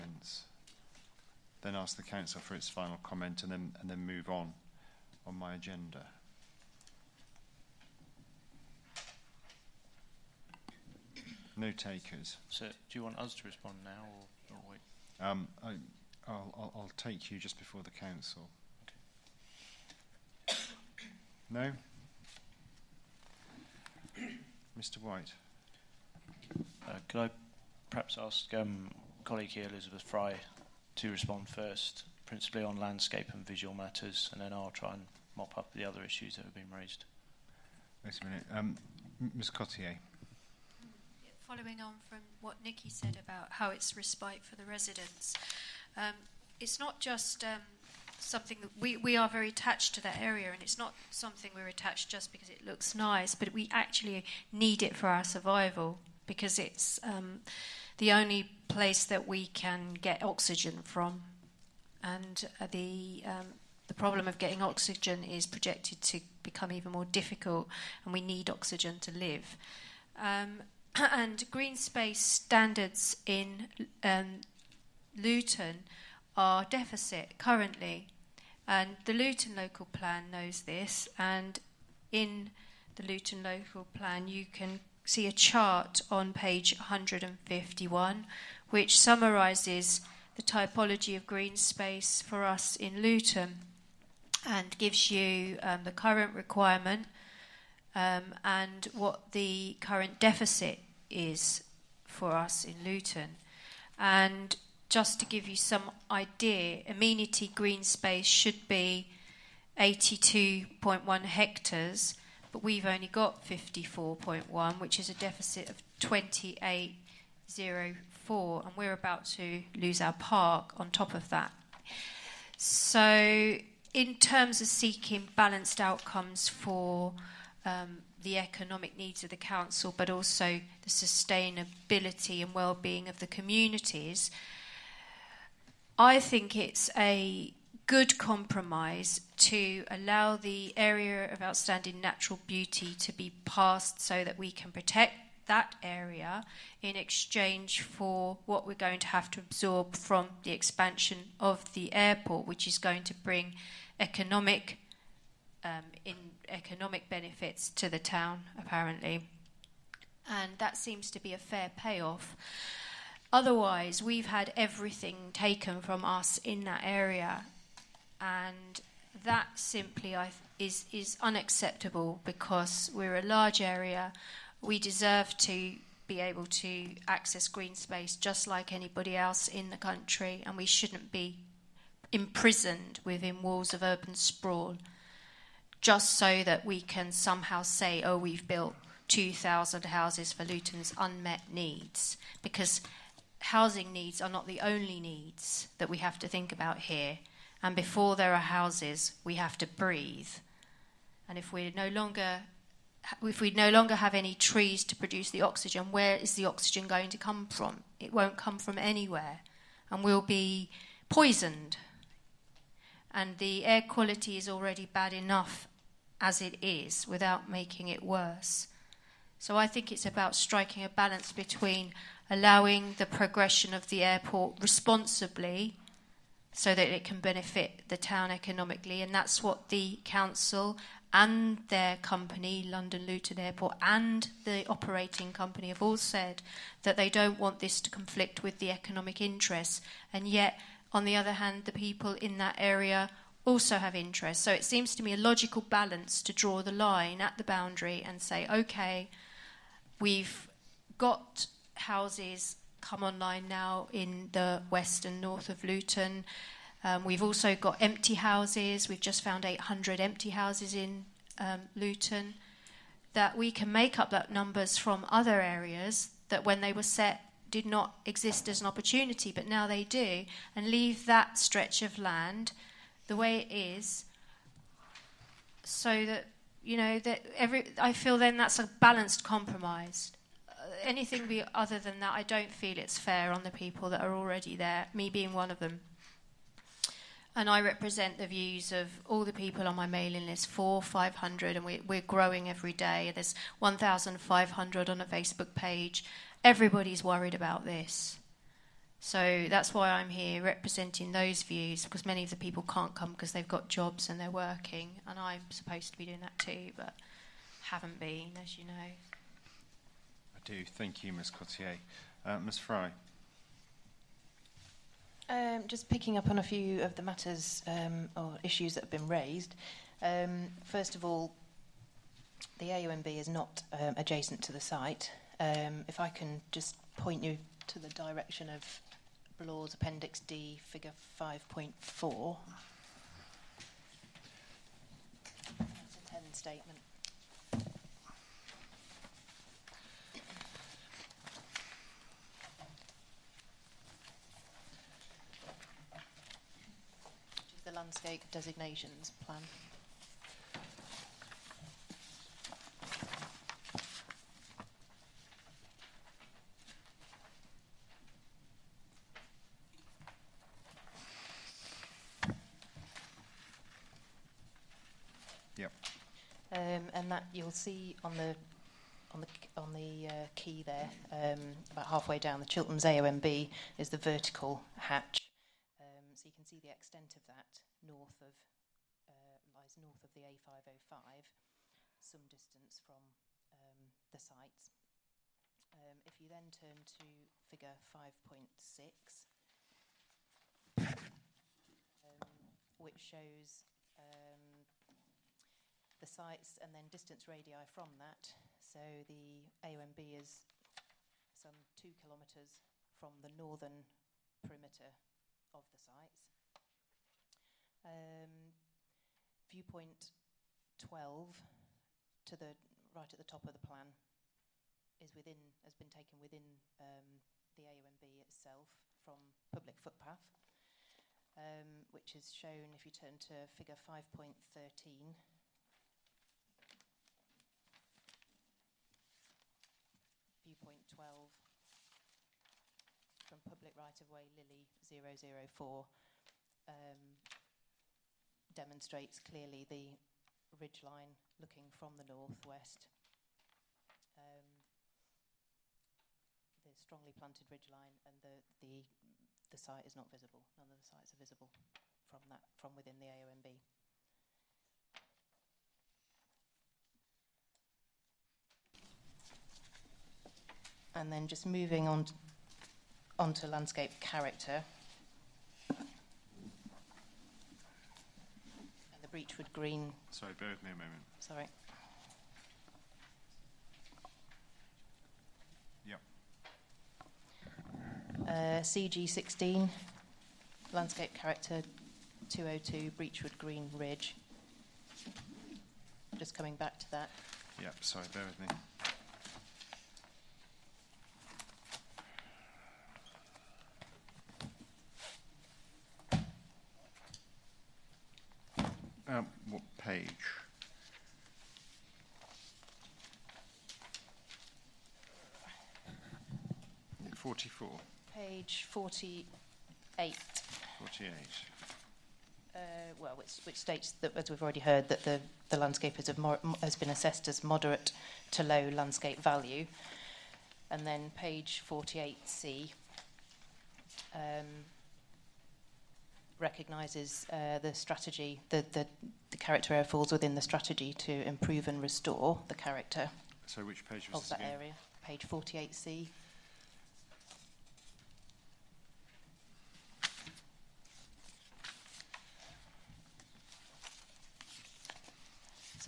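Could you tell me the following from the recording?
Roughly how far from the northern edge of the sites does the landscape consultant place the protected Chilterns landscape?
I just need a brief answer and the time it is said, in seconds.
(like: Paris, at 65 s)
2 kilometres, at 401 s.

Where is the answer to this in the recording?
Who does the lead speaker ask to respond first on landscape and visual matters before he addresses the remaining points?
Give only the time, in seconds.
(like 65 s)
29 s.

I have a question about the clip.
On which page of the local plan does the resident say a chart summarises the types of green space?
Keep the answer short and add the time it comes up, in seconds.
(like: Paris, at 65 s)
page 151, at 86 s.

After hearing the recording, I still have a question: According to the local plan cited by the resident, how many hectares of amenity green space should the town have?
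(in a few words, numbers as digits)
82.1 hectares.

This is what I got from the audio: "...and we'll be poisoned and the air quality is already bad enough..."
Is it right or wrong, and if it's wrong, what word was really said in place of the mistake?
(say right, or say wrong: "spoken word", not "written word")
right.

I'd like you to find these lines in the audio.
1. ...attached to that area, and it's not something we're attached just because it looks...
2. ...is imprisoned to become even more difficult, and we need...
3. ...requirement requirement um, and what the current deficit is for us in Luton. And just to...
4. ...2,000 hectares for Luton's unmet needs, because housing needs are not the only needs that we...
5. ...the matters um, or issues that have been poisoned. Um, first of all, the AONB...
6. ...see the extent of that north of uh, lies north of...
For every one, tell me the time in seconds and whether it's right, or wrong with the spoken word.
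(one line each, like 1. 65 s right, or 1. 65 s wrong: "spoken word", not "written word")
1. 49 s right
2. 65 s wrong: "projected", not "imprisoned"
3. 95 s wrong: "current", not "requirement"
4. 189 s wrong: "houses", not "hectares"
5. 316 s wrong: "raised", not "poisoned"
6. 376 s right.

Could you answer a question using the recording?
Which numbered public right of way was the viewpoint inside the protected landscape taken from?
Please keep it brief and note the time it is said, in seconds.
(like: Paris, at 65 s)
Lilley 004, at 434 s.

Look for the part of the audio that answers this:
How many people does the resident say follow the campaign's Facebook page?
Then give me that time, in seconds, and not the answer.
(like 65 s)
293 s.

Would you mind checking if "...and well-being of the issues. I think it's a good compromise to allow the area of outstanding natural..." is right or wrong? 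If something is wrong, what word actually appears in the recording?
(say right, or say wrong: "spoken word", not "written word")
wrong: "communities", not "issues".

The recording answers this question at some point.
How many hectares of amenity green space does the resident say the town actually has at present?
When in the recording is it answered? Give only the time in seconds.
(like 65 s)
113 s.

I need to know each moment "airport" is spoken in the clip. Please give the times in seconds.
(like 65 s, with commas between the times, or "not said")
151 s, 224 s, 233 s.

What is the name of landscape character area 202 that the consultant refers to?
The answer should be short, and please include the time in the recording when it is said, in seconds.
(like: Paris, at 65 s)
Breachwood Green Ridge, at 482 s.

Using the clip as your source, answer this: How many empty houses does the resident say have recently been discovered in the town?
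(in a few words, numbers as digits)
800.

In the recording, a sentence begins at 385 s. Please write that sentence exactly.
Um, if you then turn to figure 5.6, um, which shows um, the sites and then distance radii from that.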